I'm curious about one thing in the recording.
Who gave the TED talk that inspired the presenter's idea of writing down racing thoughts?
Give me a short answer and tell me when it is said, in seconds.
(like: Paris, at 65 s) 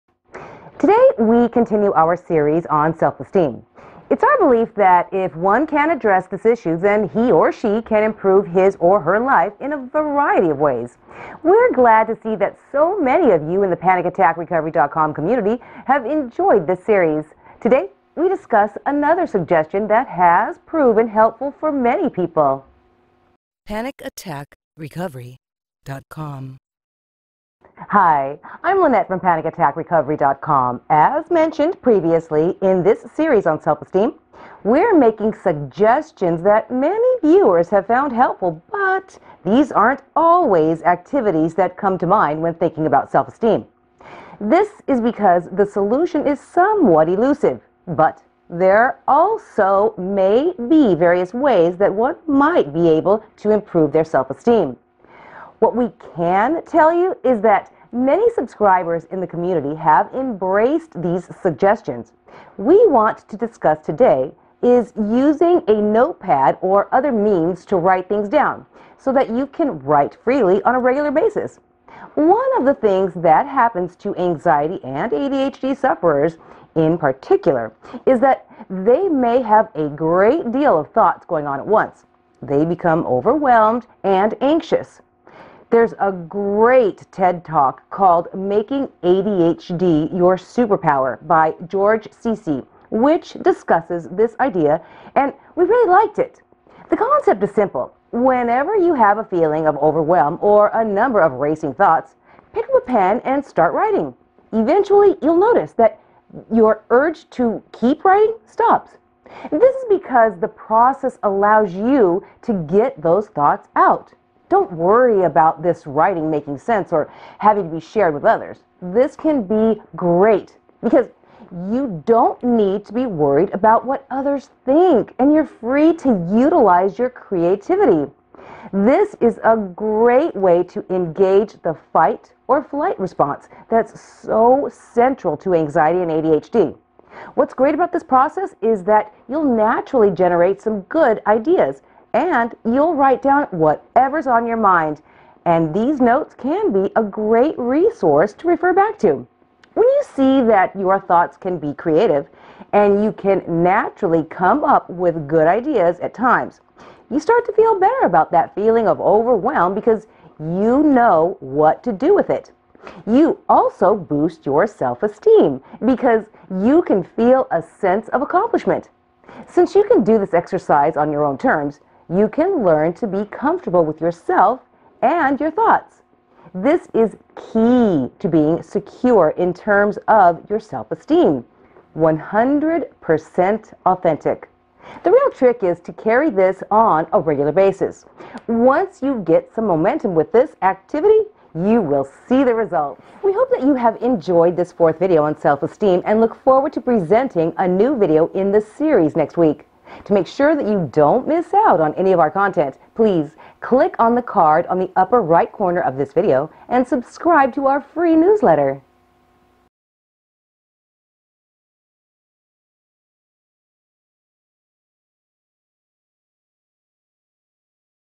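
George Cece, at 91 s.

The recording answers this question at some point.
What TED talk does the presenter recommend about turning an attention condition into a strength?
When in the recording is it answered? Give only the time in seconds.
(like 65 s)
88 s.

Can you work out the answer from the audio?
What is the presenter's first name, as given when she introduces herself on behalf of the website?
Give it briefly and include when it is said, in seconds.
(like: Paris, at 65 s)
Lynette, at 28 s.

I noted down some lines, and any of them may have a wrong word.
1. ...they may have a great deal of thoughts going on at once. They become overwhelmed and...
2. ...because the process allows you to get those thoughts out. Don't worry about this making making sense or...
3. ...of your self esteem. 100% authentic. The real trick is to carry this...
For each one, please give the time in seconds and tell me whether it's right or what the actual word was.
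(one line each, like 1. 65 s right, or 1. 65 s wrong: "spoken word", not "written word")
1. 78 s right
2. 109 s wrong: "writing", not "making"
3. 180 s right.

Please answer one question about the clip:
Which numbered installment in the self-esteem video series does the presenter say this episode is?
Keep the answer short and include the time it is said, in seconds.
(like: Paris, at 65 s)
fourth, at 194 s.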